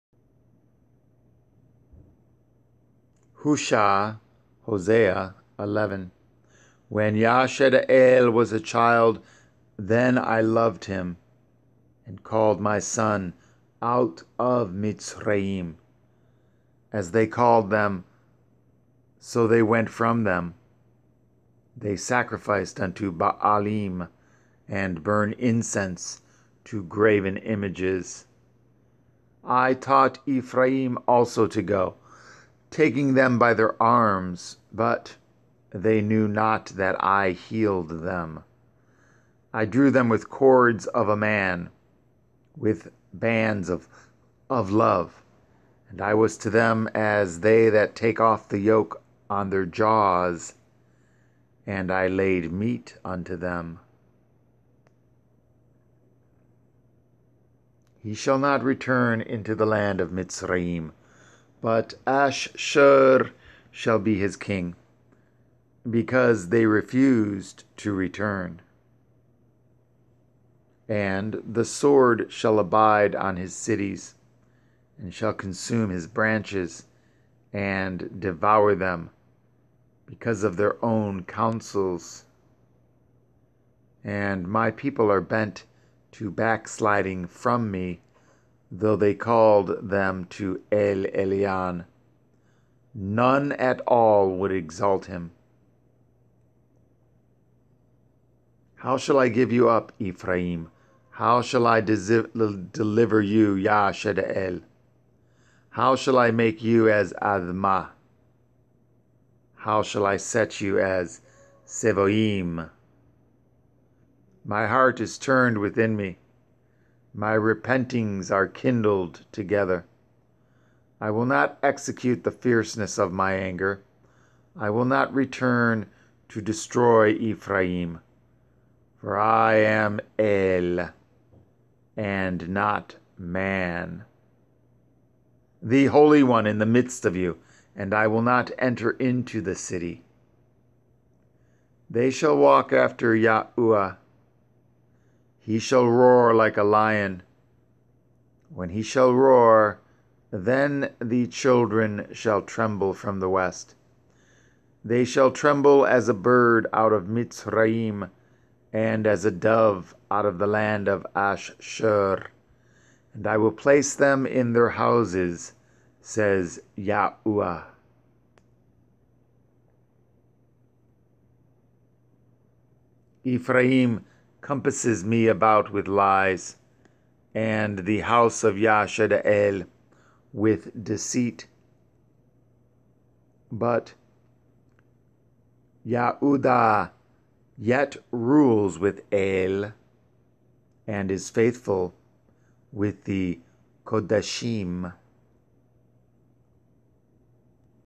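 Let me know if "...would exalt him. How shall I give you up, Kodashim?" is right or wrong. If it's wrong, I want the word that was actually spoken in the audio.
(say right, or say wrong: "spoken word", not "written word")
wrong: "Ephraim", not "Kodashim".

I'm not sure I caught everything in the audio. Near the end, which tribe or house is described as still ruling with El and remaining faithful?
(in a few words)
Yehuda.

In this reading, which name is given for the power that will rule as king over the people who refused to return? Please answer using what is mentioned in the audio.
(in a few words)
Ash-shur.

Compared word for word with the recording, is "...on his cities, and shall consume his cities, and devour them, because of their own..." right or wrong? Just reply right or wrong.
wrong.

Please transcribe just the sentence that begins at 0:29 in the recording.
I taught Ephraim also to go taking them by their arms, but they knew not that I healed them.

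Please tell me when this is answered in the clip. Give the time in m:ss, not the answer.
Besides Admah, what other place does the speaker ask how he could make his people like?
1:51.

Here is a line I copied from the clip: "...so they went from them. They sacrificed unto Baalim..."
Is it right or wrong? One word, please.
right.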